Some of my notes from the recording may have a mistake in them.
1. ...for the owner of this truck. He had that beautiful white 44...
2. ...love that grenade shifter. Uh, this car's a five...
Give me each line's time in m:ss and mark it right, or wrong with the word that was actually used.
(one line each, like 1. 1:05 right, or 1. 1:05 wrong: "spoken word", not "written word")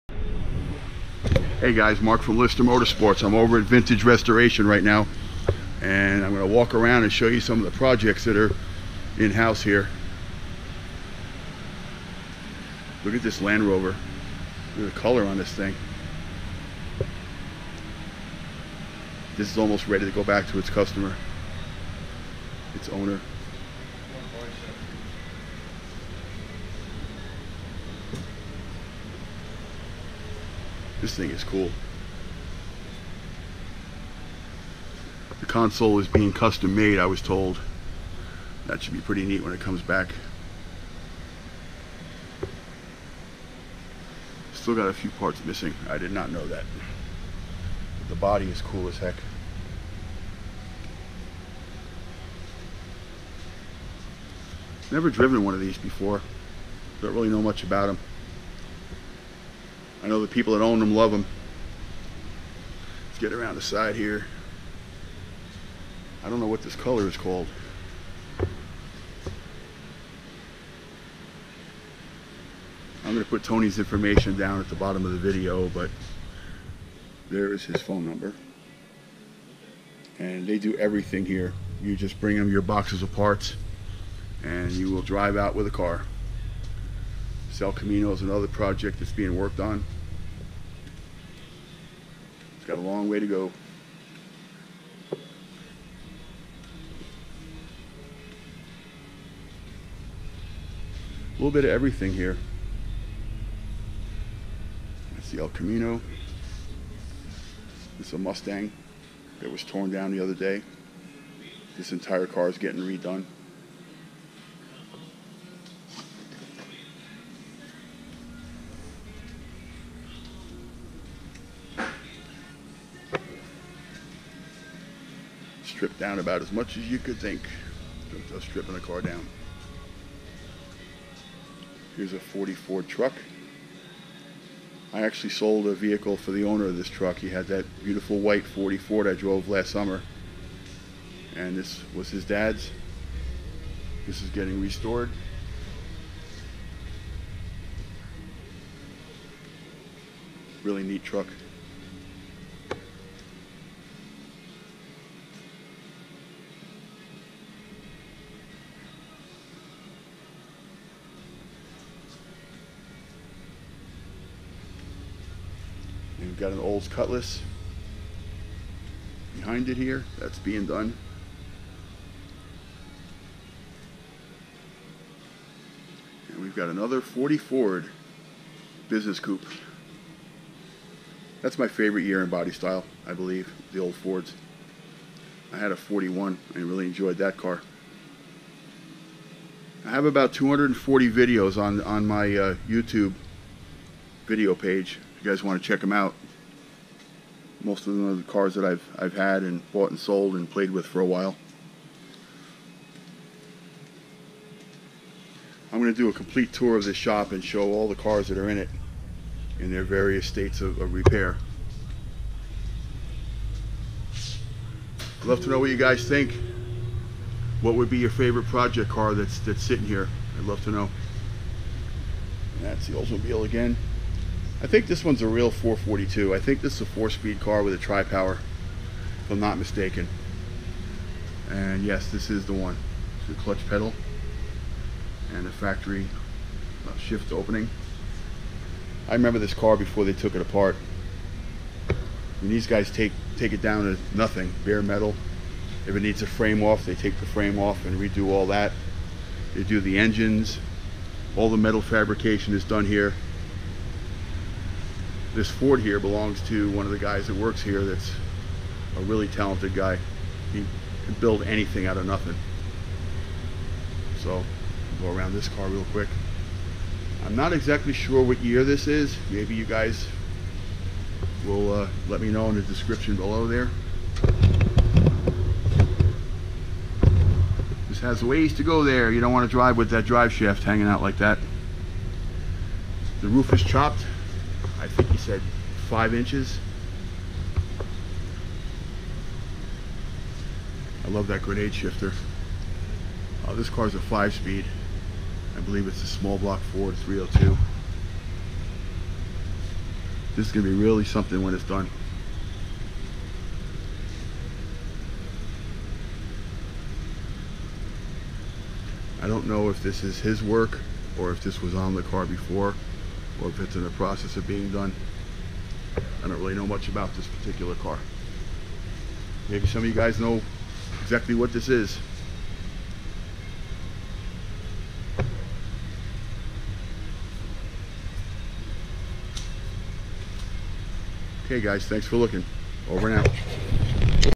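1. 2:16 right
2. 4:51 right.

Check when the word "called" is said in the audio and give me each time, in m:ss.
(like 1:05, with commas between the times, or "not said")
1:07.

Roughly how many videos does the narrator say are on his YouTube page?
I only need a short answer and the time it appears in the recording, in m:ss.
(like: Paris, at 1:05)
240, at 3:10.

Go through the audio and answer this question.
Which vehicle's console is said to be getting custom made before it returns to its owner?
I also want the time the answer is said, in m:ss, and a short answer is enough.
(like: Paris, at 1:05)
Land Rover, at 0:13.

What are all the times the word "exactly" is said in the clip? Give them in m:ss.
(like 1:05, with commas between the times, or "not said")
4:27, 5:21.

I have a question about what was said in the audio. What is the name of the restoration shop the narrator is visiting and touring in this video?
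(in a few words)
Vintage Restoration.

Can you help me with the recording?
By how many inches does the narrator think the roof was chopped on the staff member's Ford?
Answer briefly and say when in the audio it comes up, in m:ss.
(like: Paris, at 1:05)
5, at 4:45.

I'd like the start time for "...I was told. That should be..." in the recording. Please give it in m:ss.
0:36.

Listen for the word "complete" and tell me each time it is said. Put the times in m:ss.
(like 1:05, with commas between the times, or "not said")
3:26.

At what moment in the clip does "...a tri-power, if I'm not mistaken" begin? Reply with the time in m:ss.
3:47.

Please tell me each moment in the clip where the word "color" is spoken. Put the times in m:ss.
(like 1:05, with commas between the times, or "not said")
0:14, 1:06.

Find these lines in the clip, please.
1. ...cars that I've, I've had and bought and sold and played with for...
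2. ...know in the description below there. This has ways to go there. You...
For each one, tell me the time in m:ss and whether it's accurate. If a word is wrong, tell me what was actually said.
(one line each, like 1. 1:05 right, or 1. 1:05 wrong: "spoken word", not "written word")
1. 3:18 right
2. 4:32 right.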